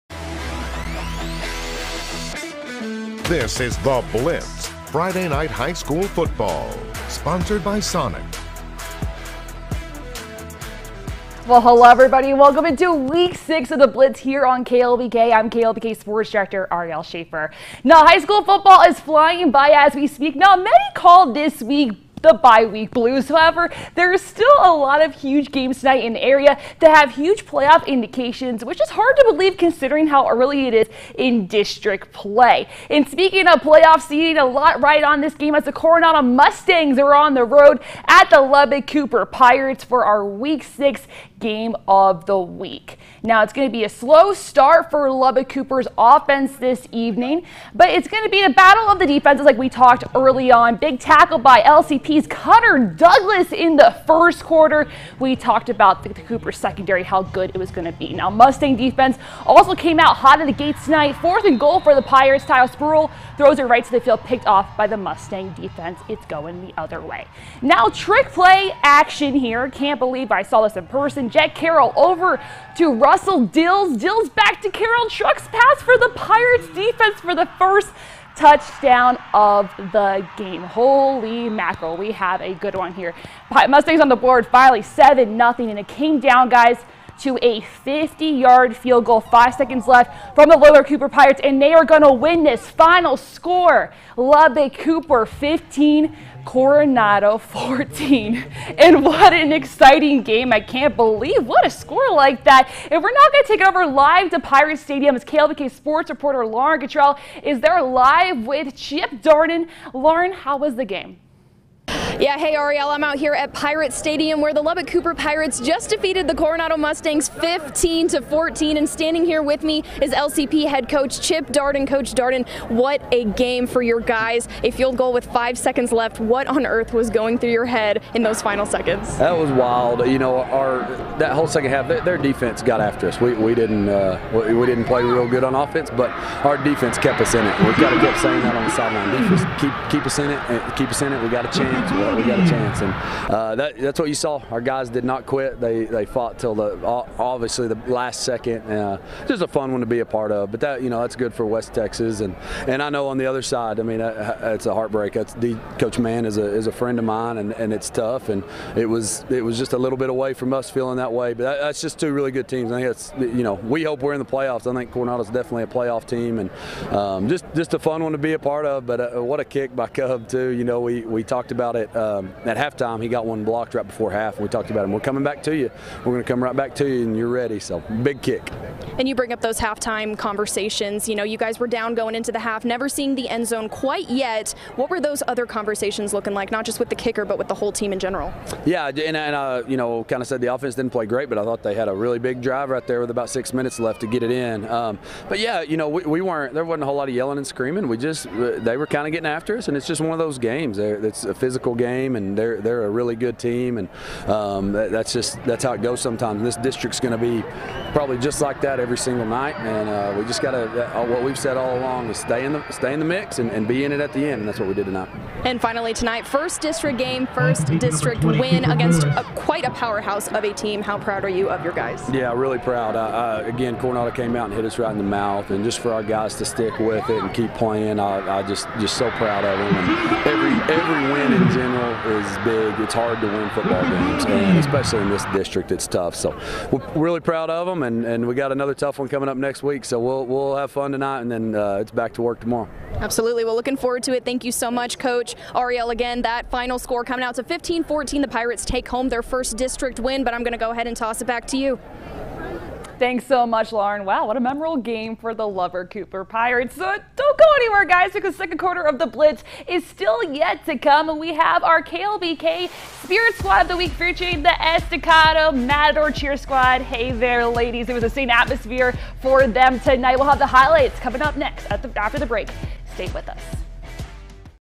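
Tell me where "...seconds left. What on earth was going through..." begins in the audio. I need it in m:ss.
2:05.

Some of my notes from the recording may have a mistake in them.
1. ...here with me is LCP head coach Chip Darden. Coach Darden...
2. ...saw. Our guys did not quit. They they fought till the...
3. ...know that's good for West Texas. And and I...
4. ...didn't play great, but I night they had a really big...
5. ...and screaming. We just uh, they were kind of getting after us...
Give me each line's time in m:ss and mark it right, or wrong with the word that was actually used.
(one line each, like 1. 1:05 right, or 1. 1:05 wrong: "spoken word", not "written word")
1. 1:59 right
2. 2:24 right
3. 2:30 right
4. 3:10 wrong: "thought", not "night"
5. 3:17 right.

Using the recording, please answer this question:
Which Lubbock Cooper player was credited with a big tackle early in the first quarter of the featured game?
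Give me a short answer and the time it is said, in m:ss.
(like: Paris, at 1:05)
Cutter Douglas, at 0:52.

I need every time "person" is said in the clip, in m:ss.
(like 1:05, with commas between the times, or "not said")
1:10.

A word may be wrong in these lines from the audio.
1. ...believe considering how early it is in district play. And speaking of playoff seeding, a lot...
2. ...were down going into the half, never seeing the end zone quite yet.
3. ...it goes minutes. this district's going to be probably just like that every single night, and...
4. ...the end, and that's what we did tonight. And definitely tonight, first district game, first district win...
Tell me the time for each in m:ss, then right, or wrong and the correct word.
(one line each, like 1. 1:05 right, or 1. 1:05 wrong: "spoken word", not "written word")
1. 0:29 right
2. 3:01 right
3. 3:25 wrong: "sometimes", not "minutes"
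4. 3:34 wrong: "finally", not "definitely".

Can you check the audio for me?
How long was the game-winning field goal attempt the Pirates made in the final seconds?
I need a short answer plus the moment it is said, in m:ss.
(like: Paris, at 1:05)
50 yards, at 1:27.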